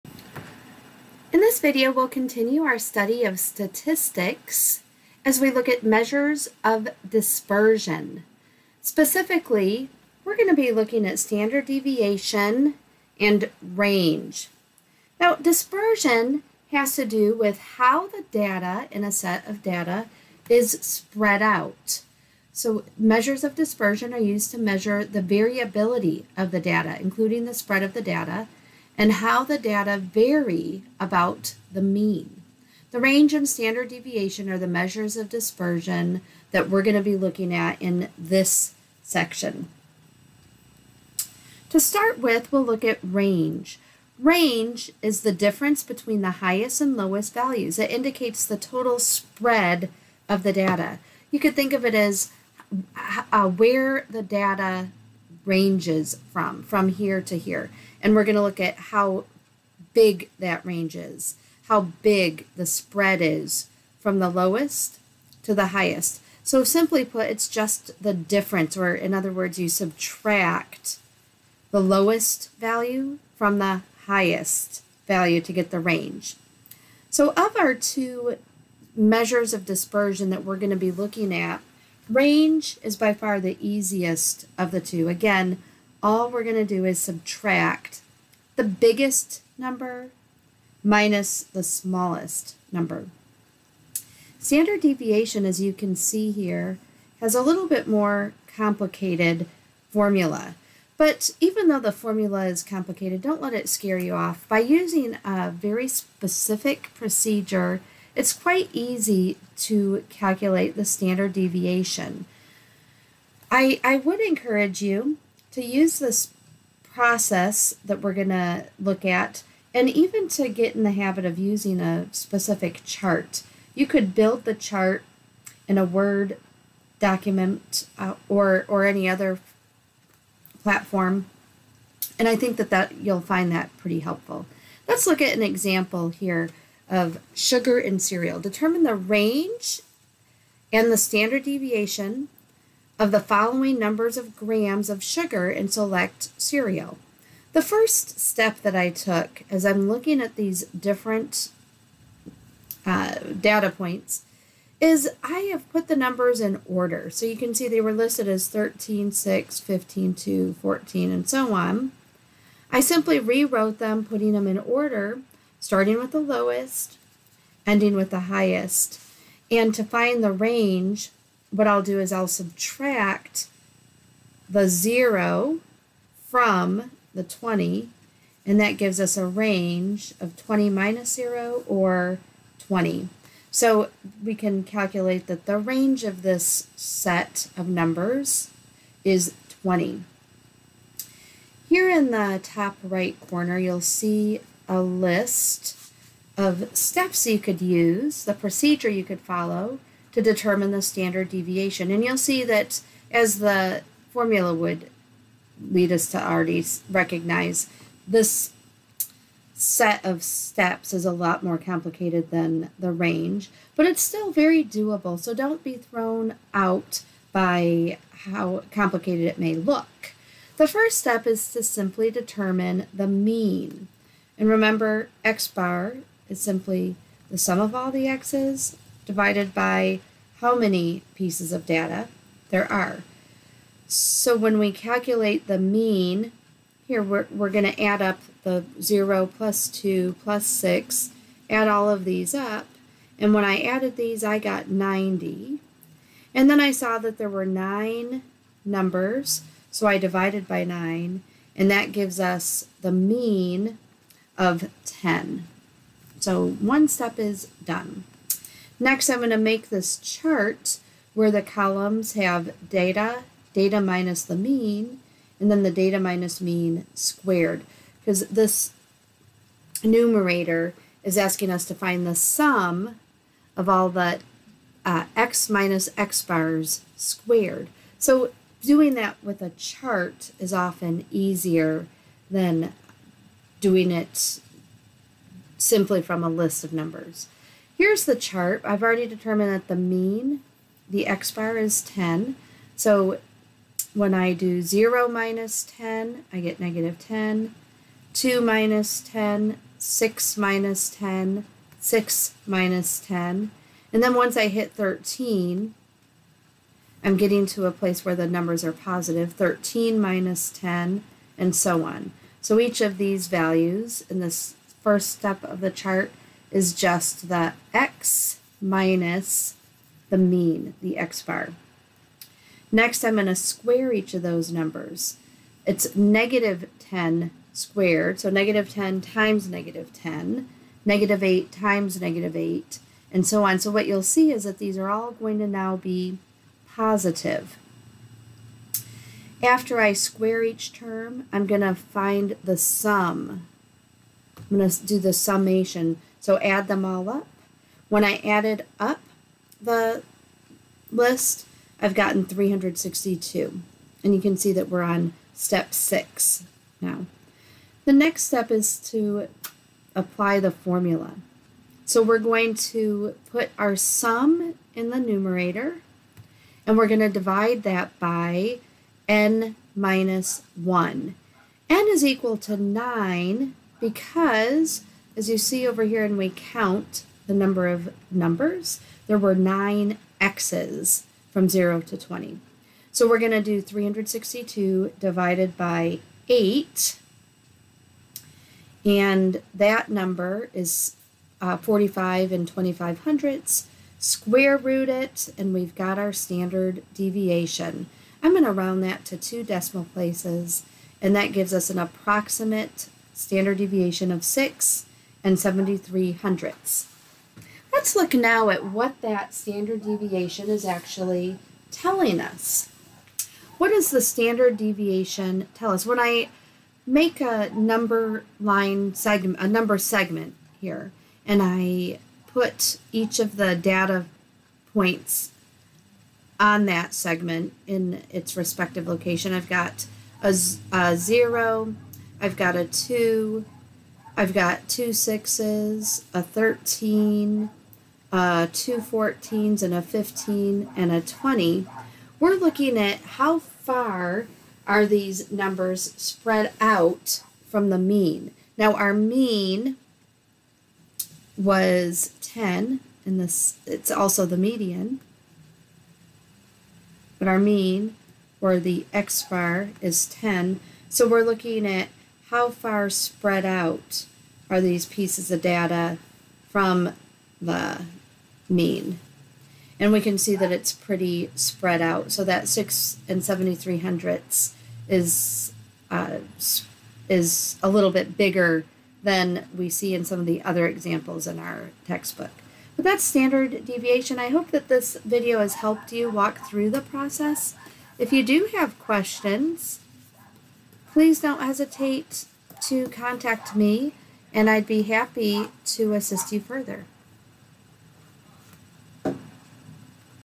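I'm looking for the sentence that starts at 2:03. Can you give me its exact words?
You could build the chart in a Word document uh, or, or any other platform.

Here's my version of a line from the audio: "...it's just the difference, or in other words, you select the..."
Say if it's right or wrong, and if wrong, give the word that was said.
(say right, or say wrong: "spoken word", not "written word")
wrong: "subtract", not "select".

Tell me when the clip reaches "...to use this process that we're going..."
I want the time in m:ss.
1:55.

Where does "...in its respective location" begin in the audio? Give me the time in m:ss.
7:07.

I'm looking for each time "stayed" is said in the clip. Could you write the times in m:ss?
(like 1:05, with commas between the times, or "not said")
not said.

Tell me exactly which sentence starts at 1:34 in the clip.
Standard deviation, as you can see here, has a little bit more complicated formula.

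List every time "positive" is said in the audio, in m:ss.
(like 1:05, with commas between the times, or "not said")
5:08, 5:36.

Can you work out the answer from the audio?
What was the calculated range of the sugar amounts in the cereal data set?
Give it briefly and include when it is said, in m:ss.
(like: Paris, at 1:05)
20, at 2:59.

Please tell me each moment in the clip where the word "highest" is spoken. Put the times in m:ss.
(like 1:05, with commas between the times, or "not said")
0:46, 1:05, 1:14, 2:48.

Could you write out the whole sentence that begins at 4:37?
So doing that with a chart is often easier than doing it simply from a list of numbers.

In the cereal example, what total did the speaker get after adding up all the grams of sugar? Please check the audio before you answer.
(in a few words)
90.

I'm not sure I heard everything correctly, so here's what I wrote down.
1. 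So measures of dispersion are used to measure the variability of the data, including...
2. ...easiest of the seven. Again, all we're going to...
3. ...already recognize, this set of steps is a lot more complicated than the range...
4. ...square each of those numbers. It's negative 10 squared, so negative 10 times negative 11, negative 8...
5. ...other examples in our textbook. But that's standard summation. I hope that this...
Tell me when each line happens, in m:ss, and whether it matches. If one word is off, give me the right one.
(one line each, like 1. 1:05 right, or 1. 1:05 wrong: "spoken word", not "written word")
1. 0:22 right
2. 1:23 wrong: "two", not "seven"
3. 3:26 right
4. 5:23 wrong: "10", not "11"
5. 8:00 wrong: "deviation", not "summation".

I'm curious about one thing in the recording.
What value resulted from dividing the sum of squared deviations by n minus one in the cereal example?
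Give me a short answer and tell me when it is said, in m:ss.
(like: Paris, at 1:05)
45.25, at 6:31.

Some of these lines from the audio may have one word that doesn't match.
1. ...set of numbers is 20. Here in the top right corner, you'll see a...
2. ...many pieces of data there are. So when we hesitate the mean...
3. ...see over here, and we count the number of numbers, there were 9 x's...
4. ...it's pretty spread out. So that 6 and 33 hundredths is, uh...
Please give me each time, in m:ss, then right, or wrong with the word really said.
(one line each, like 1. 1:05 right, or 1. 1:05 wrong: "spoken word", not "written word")
1. 3:06 right
2. 3:50 wrong: "calculate", not "hesitate"
3. 6:15 right
4. 7:50 wrong: "73", not "33".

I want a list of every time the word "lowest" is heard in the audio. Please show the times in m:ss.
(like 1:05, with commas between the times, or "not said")
0:46, 1:04, 1:11, 2:46.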